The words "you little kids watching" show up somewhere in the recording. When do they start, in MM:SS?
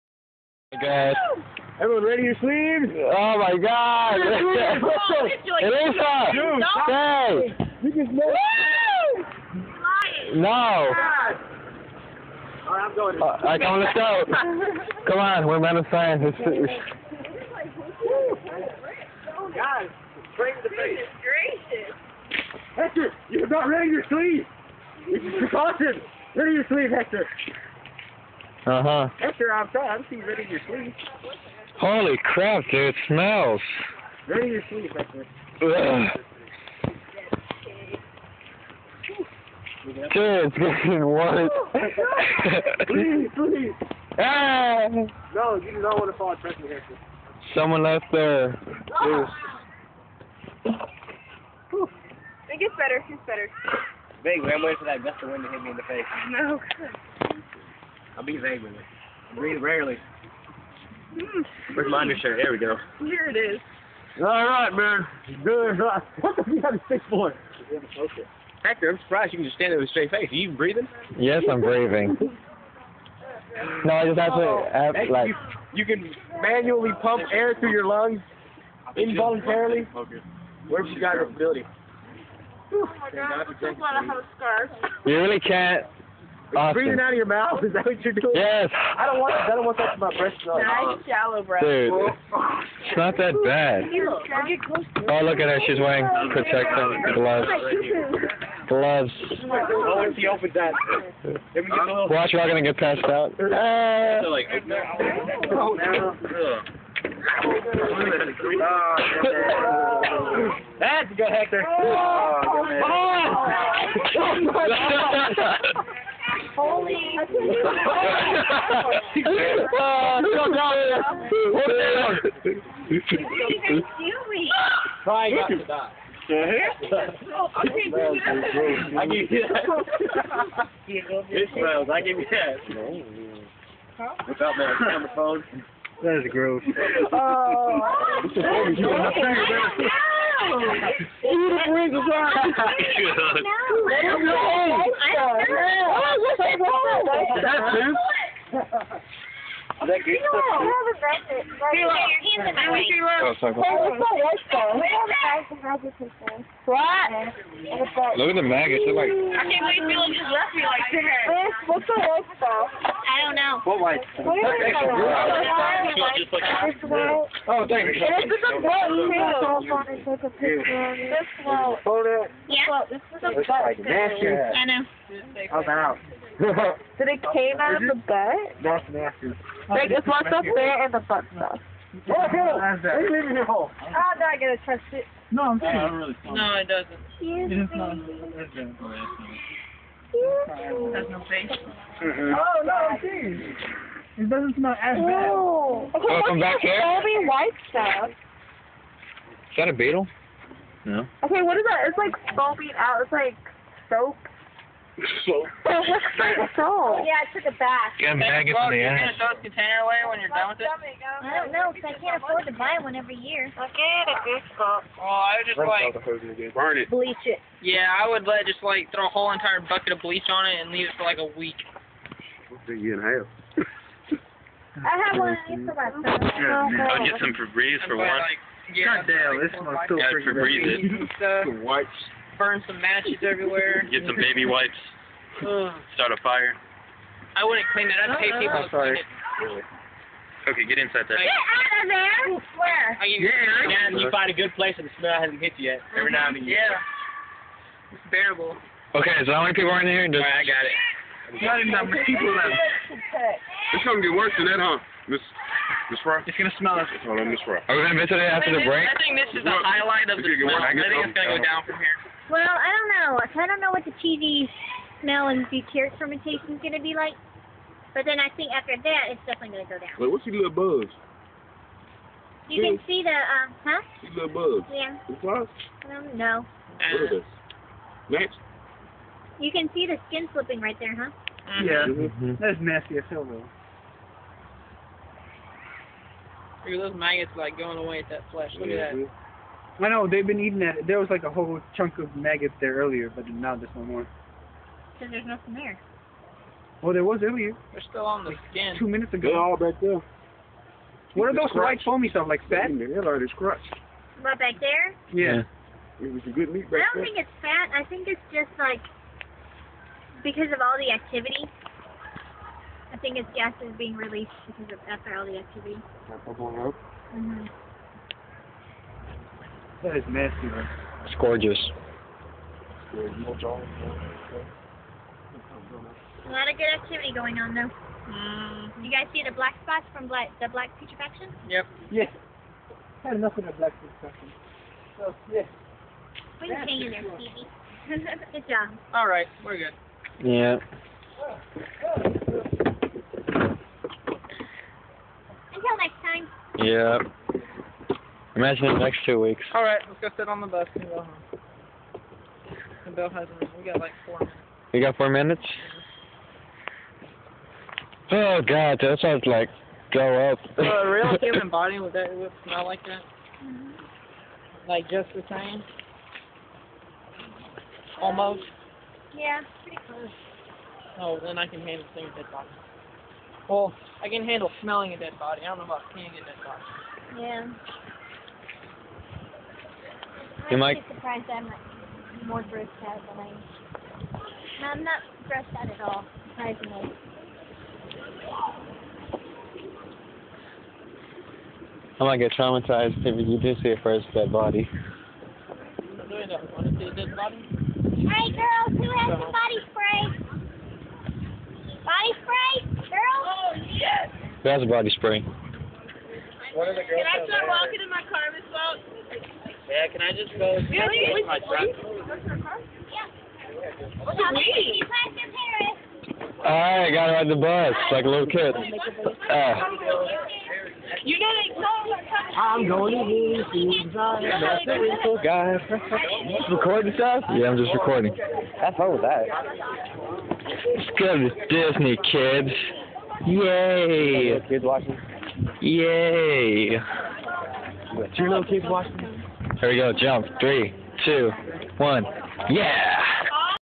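07:18.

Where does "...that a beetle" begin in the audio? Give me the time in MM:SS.
03:19.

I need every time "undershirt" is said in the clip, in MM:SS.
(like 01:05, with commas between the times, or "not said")
01:02.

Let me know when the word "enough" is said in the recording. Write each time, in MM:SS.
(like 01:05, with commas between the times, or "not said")
04:11, 05:33.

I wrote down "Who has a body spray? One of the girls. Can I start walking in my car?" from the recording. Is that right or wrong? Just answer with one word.
right.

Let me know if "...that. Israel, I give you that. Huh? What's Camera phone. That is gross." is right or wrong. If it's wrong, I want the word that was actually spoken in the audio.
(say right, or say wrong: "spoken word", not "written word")
right.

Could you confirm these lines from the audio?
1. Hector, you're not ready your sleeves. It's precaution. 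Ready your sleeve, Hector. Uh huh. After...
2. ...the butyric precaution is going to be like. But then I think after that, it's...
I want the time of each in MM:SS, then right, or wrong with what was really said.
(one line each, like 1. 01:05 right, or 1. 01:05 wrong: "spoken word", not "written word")
1. 00:22 right
2. 04:25 wrong: "fermentation", not "precaution".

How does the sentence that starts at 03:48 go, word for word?
Like, yeah, God damn, like this one's so freaking Febreze it.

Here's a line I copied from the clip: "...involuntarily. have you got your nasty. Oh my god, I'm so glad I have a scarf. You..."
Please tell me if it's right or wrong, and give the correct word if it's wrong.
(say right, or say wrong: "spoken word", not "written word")
wrong: "ability", not "nasty".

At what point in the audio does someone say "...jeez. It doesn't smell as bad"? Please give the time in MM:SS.
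03:12.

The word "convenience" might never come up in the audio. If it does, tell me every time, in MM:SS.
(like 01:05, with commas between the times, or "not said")
not said.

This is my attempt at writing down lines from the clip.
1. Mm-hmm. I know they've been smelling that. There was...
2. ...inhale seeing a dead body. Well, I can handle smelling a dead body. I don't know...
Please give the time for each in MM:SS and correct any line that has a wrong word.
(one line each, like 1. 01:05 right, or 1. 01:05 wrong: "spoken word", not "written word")
1. 04:49 wrong: "eating", not "smelling"
2. 06:11 wrong: "handle", not "inhale".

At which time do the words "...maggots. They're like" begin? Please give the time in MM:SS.
02:38.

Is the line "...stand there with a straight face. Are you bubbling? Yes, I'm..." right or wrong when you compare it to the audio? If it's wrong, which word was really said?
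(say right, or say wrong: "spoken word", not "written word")
wrong: "breathing", not "bubbling".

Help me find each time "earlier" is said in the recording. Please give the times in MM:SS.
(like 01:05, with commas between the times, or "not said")
04:52, 04:57.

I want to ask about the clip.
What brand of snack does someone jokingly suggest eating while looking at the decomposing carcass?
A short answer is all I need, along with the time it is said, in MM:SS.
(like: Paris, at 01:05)
Pringles, at 02:21.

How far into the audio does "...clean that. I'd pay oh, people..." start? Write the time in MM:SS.
03:57.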